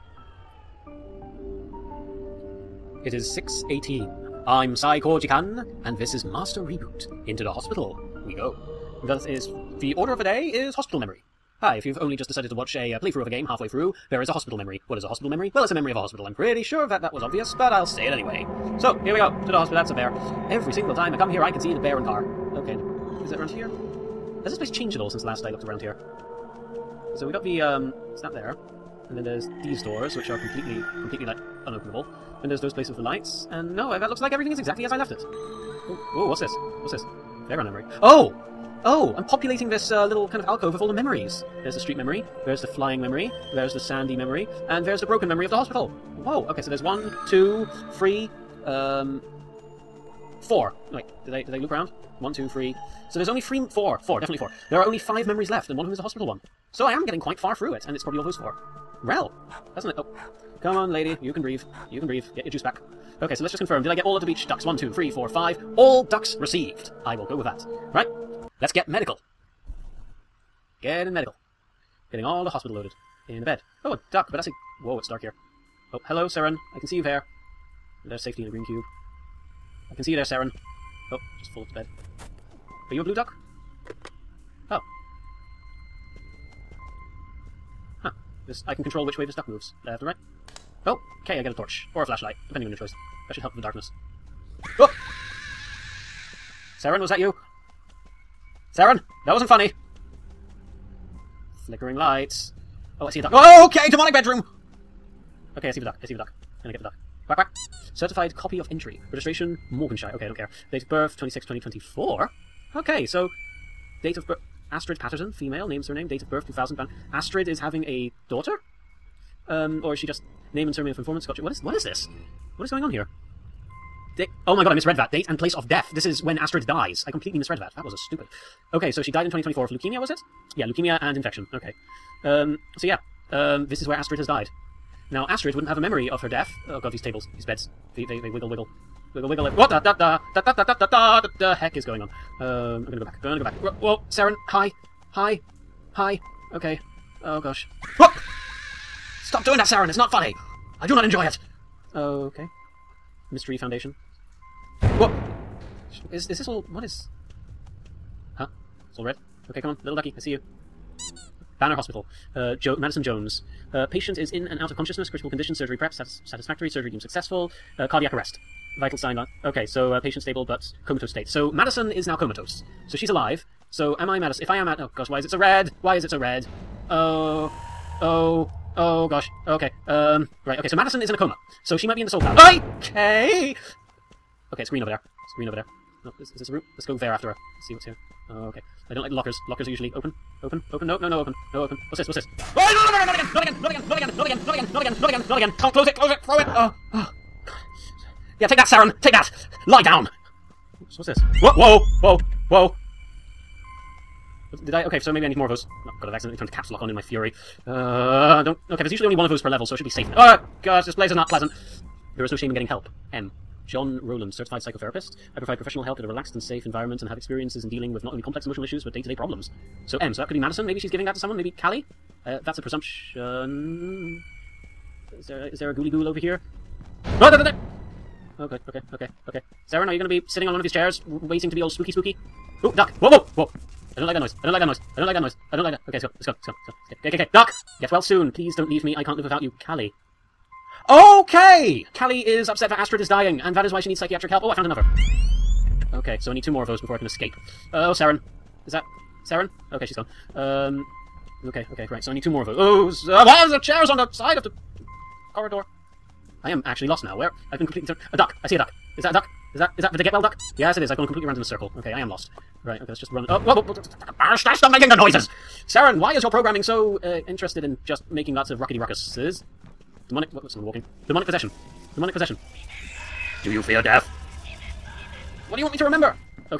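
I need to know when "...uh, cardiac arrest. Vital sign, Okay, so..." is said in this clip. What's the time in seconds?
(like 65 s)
167 s.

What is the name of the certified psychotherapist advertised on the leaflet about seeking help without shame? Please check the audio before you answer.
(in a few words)
John Rowland.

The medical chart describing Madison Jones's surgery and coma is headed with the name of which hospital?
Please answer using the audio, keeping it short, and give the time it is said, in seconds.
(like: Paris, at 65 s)
Banner Hospital, at 161 s.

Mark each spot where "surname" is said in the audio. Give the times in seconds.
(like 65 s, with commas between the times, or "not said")
115 s, 120 s.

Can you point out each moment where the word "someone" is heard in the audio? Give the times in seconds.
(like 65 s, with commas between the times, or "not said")
221 s, 270 s.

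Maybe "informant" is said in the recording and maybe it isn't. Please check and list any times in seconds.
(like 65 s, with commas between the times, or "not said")
120 s.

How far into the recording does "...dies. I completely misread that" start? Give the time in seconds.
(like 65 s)
126 s.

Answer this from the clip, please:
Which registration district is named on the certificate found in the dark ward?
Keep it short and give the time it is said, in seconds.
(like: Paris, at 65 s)
Morganshire, at 109 s.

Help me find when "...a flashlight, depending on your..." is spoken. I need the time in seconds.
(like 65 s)
92 s.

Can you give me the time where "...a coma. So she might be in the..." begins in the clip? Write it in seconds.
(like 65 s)
181 s.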